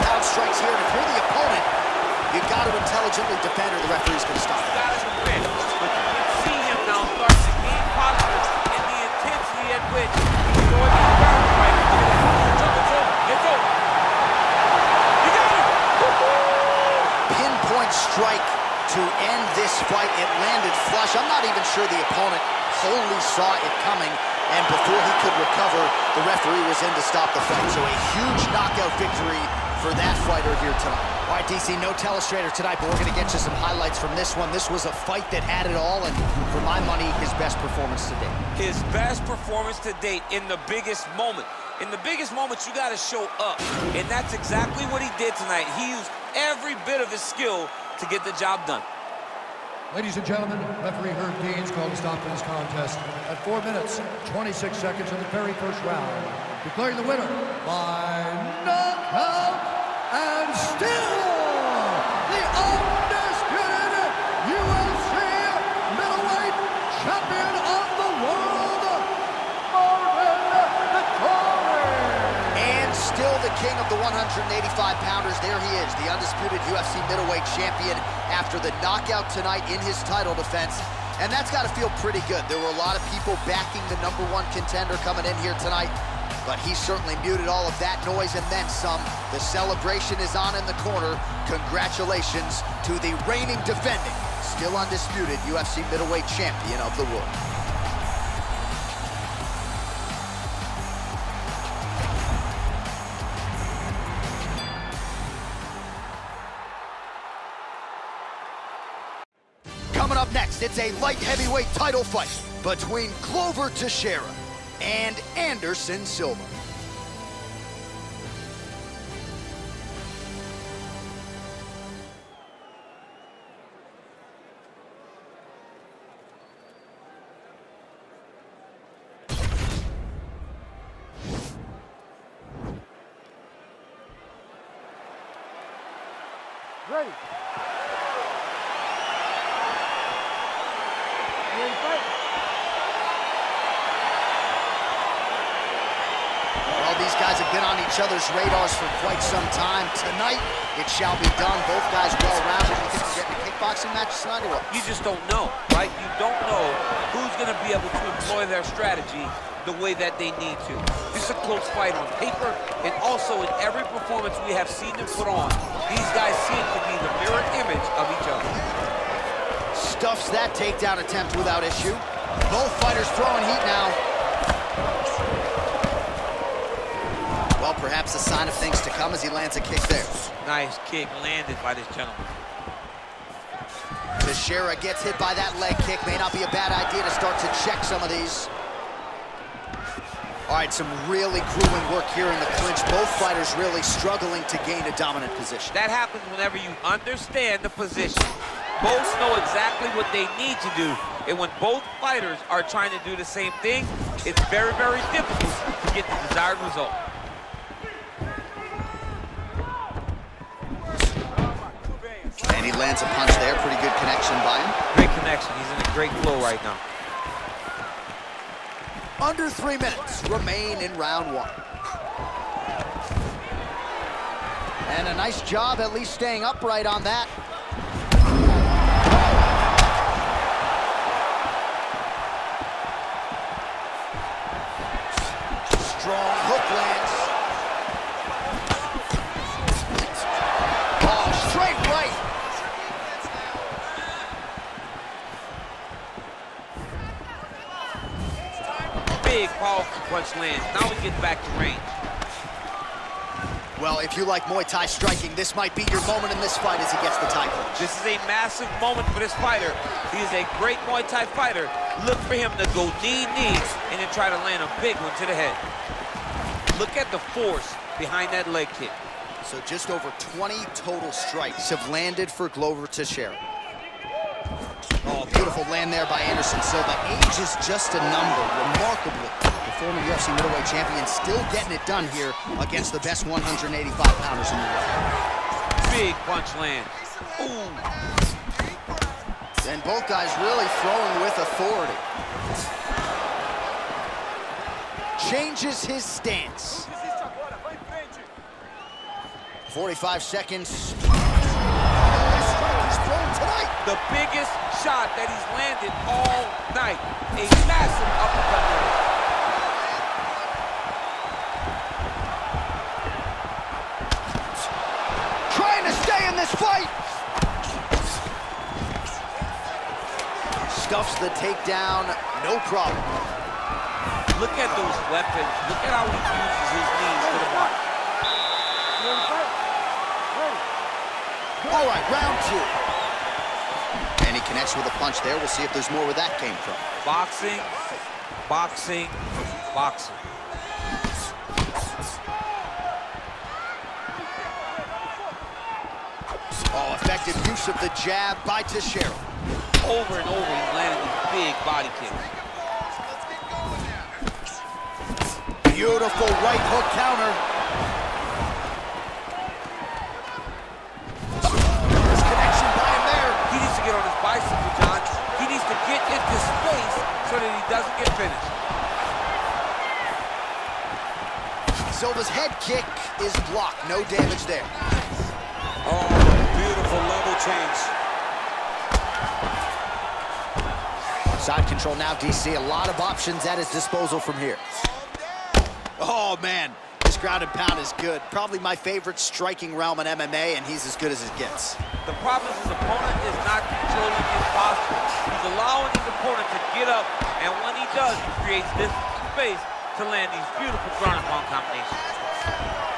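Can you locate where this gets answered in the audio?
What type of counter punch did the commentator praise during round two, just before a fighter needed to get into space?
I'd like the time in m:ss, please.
5:56.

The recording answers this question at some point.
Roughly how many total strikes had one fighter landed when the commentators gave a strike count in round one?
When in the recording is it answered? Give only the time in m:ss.
4:29.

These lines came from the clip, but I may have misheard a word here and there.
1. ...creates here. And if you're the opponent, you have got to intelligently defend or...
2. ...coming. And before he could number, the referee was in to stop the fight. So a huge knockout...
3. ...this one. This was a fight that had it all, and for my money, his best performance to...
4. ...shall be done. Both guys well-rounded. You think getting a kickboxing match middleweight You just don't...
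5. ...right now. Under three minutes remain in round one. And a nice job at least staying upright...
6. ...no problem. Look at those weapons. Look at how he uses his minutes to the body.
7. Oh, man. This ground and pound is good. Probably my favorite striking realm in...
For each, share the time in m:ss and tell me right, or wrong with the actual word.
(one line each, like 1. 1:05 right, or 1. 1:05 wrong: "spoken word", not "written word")
1. 0:00 wrong: "strikes", not "creates"
2. 0:23 wrong: "recover", not "number"
3. 0:34 right
4. 2:30 wrong: "tonight", not "middleweight"
5. 3:36 right
6. 5:22 wrong: "knees", not "minutes"
7. 6:25 right.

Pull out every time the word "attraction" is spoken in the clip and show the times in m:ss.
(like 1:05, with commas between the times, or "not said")
not said.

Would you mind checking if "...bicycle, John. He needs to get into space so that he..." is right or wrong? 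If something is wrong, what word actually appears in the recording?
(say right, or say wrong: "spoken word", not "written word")
right.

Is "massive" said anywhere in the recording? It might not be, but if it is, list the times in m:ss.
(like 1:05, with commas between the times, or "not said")
4:18, 5:07.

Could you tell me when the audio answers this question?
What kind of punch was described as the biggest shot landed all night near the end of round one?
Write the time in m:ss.
5:07.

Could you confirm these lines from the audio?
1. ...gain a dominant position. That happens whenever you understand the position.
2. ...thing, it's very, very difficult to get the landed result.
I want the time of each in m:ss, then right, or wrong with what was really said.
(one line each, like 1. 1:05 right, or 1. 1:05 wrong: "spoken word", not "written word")
1. 3:14 right
2. 3:23 wrong: "desired", not "landed".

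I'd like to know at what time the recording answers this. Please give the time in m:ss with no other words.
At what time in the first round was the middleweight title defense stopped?
0:53.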